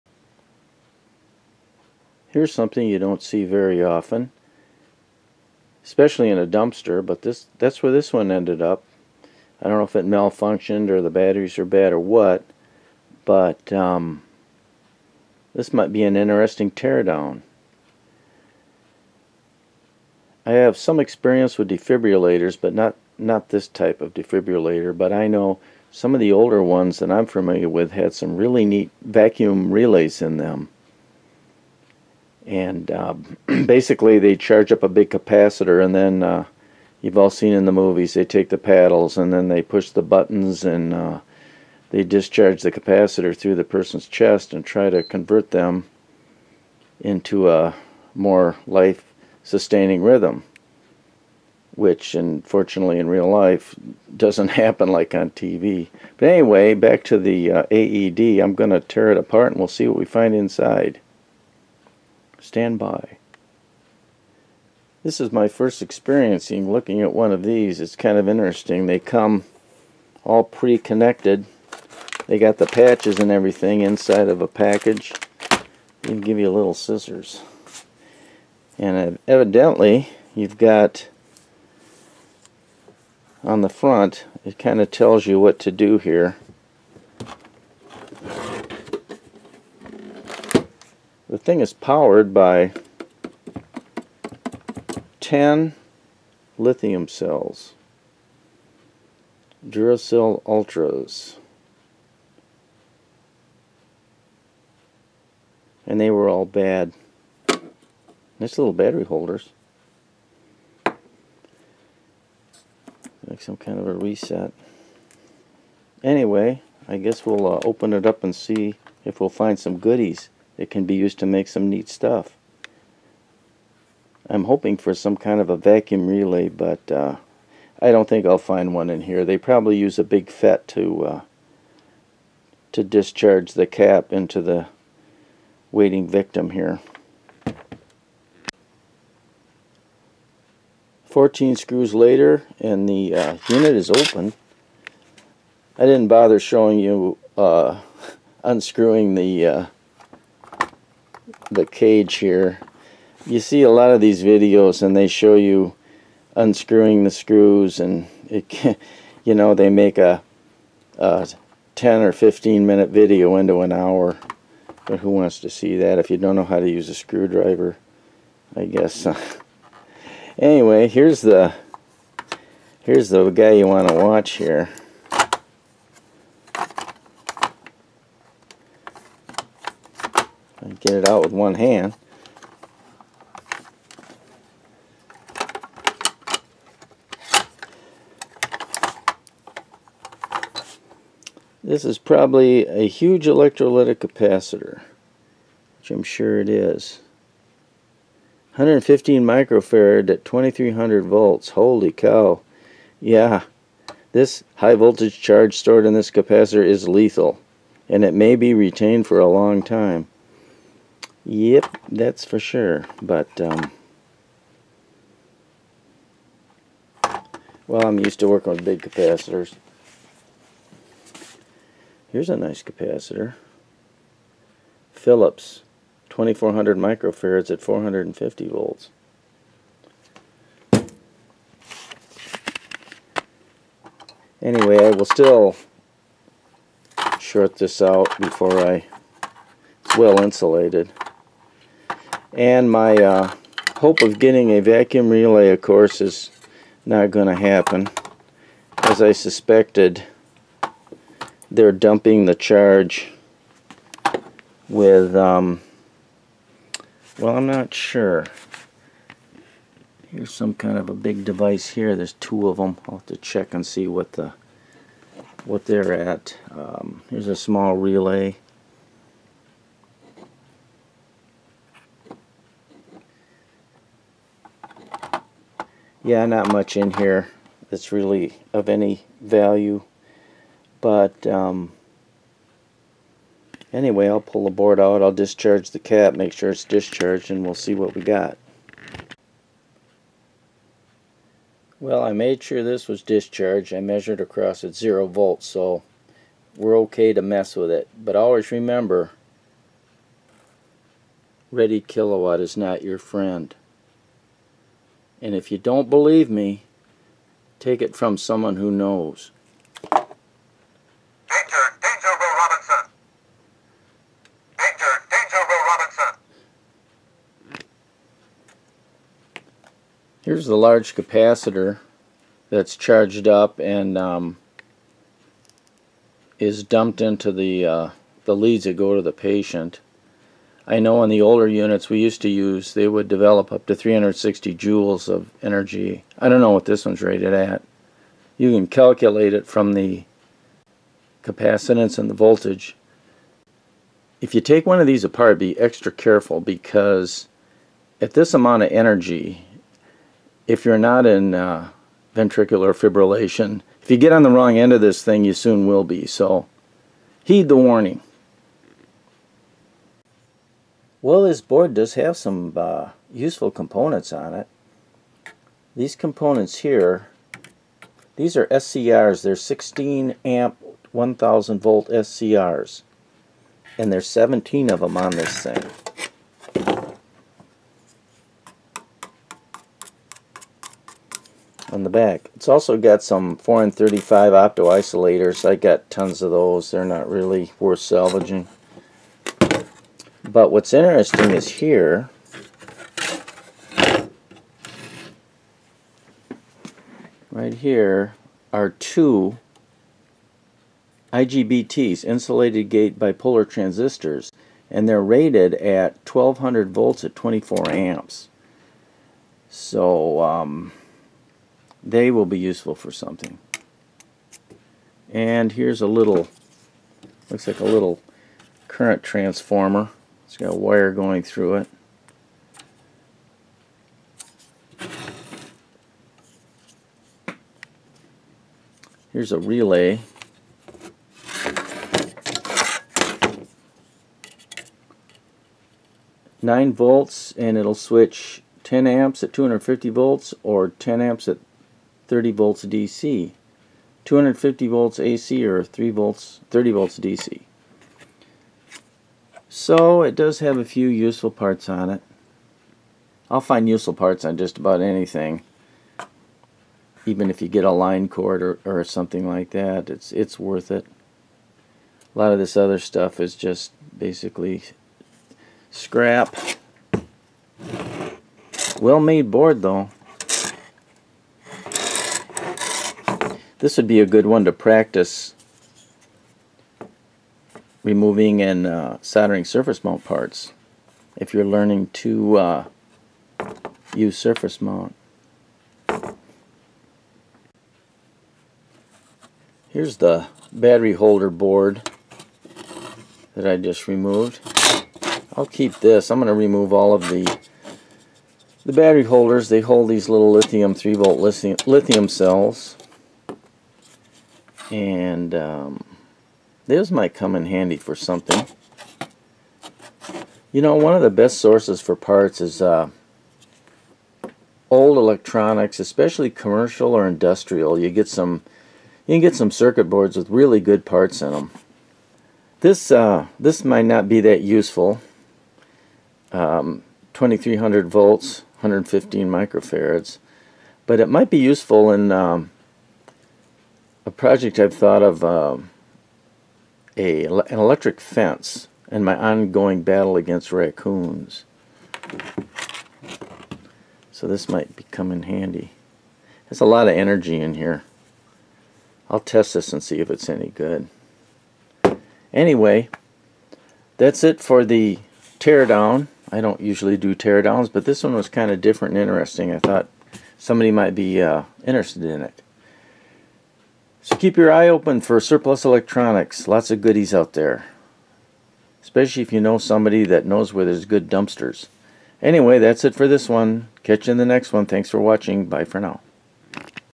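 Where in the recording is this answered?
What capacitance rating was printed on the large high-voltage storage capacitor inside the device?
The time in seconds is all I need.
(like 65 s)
198 s.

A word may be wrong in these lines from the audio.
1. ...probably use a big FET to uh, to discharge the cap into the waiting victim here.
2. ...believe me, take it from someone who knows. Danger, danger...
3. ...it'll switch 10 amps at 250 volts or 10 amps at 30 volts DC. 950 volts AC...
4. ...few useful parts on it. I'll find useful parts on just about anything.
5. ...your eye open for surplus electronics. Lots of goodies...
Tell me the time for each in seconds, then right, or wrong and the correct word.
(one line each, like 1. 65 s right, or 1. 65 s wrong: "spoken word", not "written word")
1. 129 s right
2. 305 s right
3. 437 s wrong: "250", not "950"
4. 450 s right
5. 564 s right.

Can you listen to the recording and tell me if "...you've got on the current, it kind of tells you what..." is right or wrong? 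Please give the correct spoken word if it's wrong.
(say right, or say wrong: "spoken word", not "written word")
wrong: "front", not "current".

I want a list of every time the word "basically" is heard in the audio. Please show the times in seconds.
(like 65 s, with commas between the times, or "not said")
33 s, 463 s.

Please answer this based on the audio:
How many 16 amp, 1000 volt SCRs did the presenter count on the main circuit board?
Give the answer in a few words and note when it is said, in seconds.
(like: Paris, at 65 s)
17, at 374 s.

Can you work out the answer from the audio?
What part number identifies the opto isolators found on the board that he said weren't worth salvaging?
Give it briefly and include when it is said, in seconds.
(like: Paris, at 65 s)
4N35, at 383 s.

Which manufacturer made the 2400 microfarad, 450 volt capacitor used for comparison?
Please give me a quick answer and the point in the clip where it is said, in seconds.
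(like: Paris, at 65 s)
Philips, at 224 s.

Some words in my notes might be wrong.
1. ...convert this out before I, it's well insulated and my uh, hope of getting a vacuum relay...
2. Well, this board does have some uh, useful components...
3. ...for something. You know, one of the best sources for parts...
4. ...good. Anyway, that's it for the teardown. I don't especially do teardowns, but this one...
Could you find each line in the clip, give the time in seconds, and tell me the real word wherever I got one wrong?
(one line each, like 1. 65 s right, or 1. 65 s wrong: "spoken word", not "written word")
1. 237 s wrong: "short", not "convert"
2. 361 s right
3. 507 s right
4. 550 s wrong: "usually", not "especially".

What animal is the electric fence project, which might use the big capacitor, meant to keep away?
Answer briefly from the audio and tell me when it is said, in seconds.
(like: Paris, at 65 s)
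Raccoons, at 540 s.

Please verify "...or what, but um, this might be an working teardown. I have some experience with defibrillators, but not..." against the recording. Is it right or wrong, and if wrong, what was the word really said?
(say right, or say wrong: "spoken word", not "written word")
wrong: "interesting", not "working".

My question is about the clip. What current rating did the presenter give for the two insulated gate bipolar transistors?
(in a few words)
24 amps.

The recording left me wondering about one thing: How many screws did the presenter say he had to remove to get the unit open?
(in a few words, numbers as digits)
14.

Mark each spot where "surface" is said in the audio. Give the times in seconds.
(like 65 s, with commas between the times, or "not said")
479 s, 484 s.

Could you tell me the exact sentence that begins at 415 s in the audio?
And here's a little, looks like a little current transformer.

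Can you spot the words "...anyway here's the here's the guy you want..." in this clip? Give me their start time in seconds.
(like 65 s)
170 s.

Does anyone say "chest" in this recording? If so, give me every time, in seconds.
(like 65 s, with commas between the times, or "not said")
44 s.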